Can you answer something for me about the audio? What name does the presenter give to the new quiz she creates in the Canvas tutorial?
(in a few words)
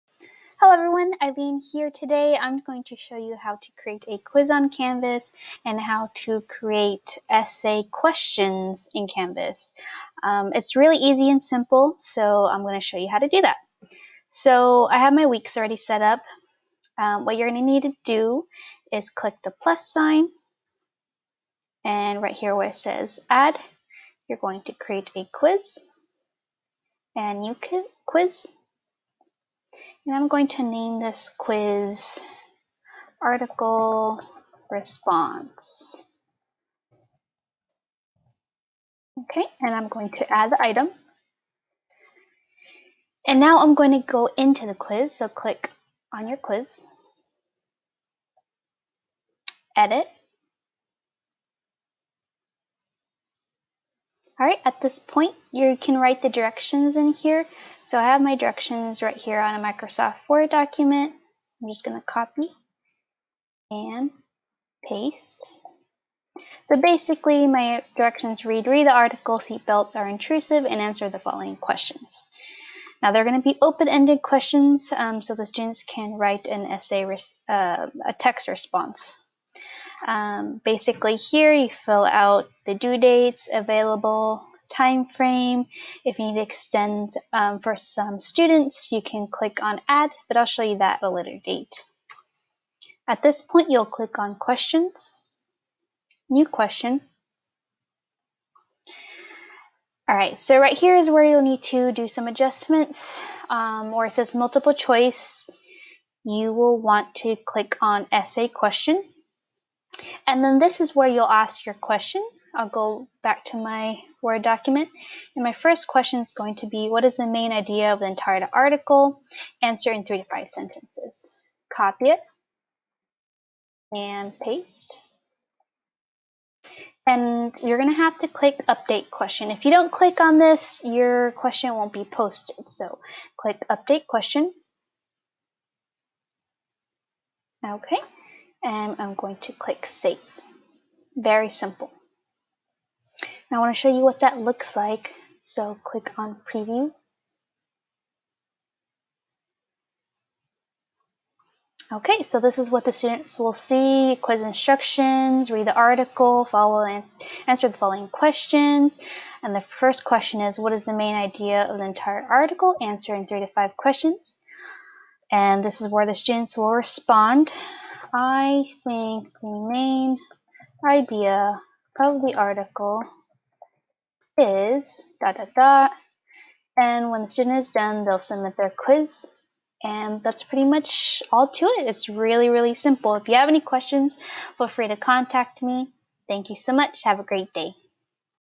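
Article response.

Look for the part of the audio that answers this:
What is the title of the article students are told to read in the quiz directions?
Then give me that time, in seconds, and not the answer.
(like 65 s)
69 s.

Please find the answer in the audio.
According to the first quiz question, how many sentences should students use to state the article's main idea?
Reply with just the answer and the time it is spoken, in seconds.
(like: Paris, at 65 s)
3 to 5, at 120 s.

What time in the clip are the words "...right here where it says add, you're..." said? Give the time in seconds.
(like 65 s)
22 s.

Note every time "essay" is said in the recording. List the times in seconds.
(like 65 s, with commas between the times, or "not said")
7 s, 76 s, 108 s.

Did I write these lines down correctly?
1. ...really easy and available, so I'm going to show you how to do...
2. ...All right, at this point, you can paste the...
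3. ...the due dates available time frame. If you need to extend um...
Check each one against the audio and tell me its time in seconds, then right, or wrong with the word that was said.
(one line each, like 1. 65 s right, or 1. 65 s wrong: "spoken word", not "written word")
1. 10 s wrong: "simple", not "available"
2. 54 s wrong: "write", not "paste"
3. 82 s right.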